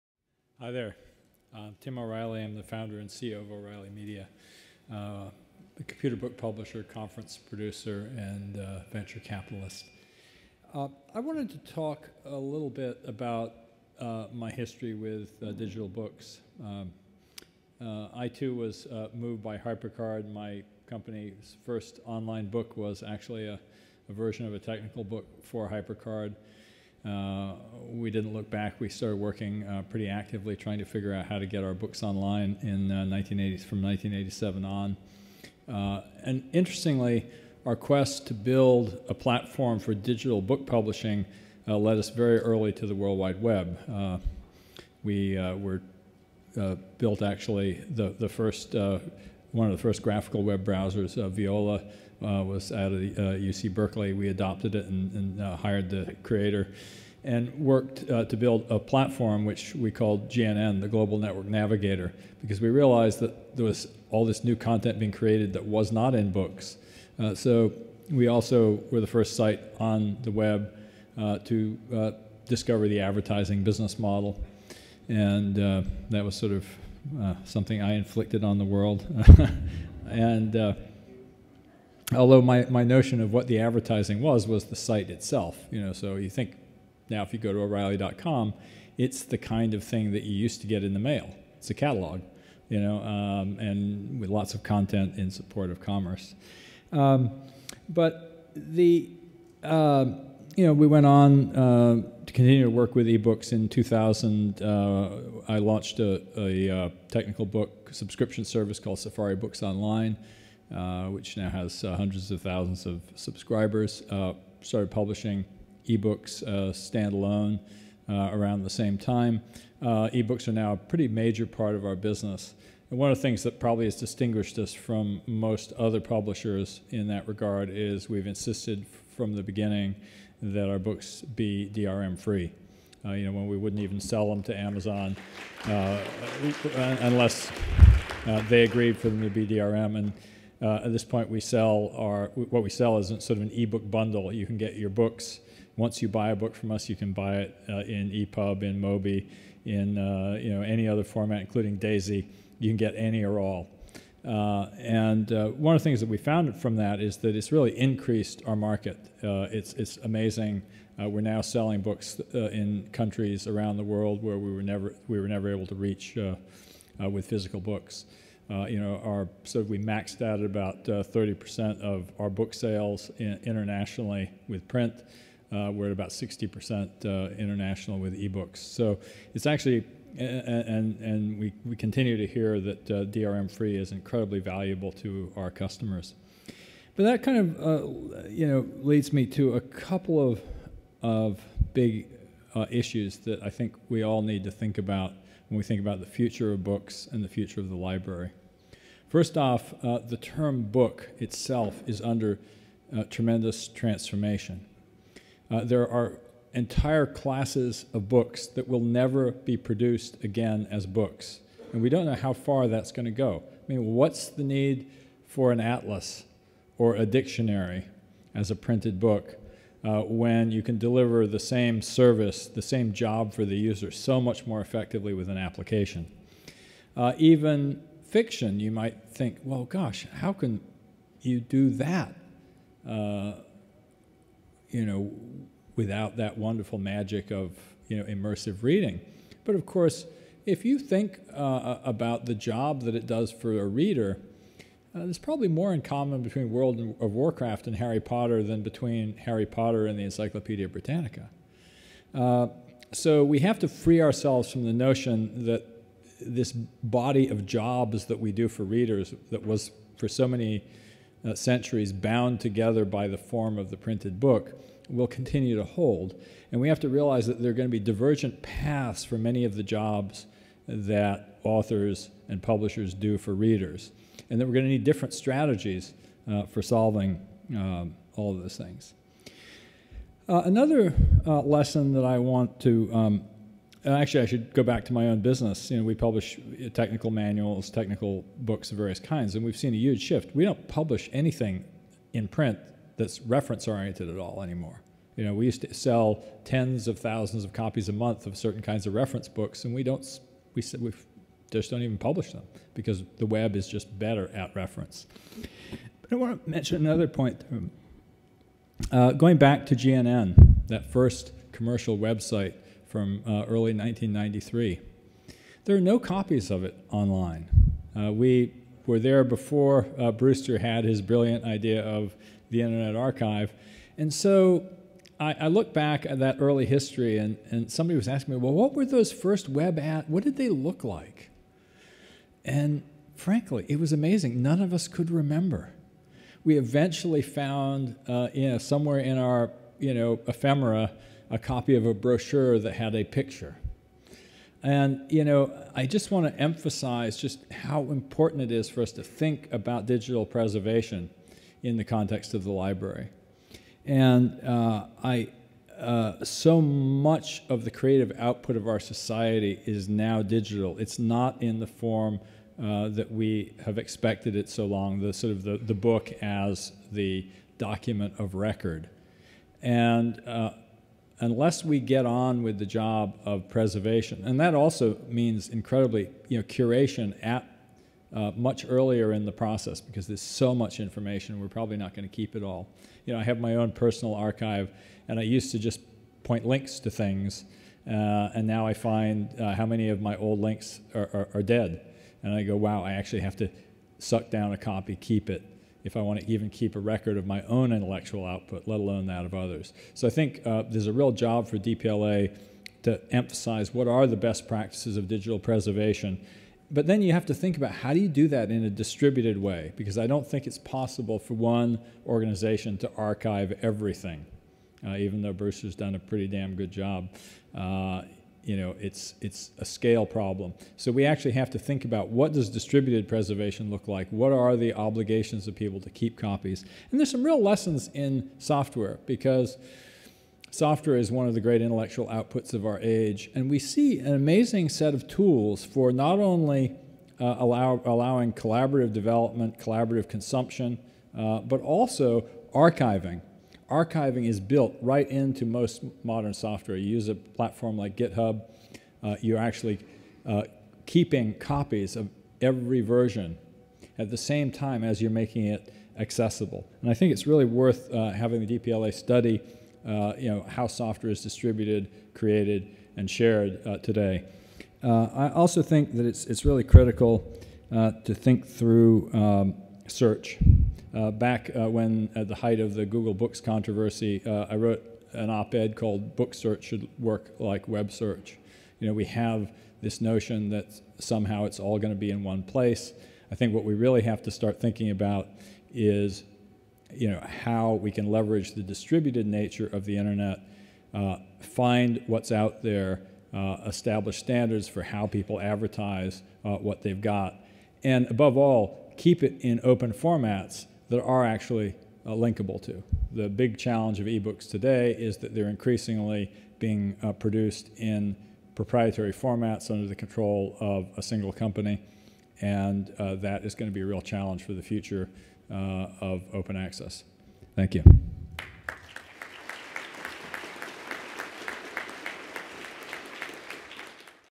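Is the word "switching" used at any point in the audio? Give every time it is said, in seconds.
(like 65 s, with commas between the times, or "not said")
not said.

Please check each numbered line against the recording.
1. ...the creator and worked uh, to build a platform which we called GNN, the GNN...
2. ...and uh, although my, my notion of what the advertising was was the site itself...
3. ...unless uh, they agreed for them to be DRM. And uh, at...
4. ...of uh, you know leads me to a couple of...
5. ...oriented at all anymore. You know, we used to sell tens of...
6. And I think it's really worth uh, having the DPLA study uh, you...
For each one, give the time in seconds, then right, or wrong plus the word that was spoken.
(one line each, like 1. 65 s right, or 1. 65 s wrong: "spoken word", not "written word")
1. 55 s wrong: "Global", not "GNN"
2. 80 s right
3. 137 s right
4. 187 s right
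5. 293 s right
6. 456 s right.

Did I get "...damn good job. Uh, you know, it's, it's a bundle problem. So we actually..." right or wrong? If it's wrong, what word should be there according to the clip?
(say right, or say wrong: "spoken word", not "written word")
wrong: "scale", not "bundle".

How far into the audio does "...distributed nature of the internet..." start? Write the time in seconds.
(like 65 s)
488 s.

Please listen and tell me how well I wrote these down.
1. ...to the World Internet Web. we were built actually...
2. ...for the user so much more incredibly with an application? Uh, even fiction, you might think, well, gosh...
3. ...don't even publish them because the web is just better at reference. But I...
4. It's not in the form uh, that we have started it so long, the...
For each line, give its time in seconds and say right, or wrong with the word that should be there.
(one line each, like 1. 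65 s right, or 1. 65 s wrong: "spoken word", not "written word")
1. 42 s wrong: "Wide", not "Internet"
2. 223 s wrong: "effectively", not "incredibly"
3. 301 s right
4. 360 s wrong: "expected", not "started".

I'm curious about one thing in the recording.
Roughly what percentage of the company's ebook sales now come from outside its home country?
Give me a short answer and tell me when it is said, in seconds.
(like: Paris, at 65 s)
60%, at 176 s.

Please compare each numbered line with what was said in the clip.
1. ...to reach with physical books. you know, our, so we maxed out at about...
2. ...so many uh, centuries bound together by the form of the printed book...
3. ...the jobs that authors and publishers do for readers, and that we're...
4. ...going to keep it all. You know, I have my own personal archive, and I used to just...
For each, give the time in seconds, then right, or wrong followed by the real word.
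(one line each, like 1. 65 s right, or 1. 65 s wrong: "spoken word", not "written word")
1. 165 s right
2. 260 s right
3. 269 s right
4. 381 s right.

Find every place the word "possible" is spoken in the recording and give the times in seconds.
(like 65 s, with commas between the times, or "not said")
410 s.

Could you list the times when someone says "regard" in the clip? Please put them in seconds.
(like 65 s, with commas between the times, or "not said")
127 s.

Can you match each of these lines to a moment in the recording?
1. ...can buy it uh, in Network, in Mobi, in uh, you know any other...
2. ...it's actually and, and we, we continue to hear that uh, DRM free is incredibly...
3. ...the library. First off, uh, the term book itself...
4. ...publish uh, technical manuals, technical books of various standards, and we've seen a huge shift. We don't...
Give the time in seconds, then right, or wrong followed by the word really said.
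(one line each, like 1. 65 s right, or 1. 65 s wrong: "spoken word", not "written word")
1. 146 s wrong: "EPUB", not "Network"
2. 179 s right
3. 197 s right
4. 285 s wrong: "kinds", not "standards".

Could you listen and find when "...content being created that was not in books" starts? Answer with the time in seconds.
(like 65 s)
64 s.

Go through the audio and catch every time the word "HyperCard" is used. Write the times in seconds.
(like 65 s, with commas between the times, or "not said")
19 s, 25 s.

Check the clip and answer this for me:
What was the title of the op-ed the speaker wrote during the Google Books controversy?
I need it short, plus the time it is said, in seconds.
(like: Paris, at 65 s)
Book Search Should Work Like Web Search, at 476 s.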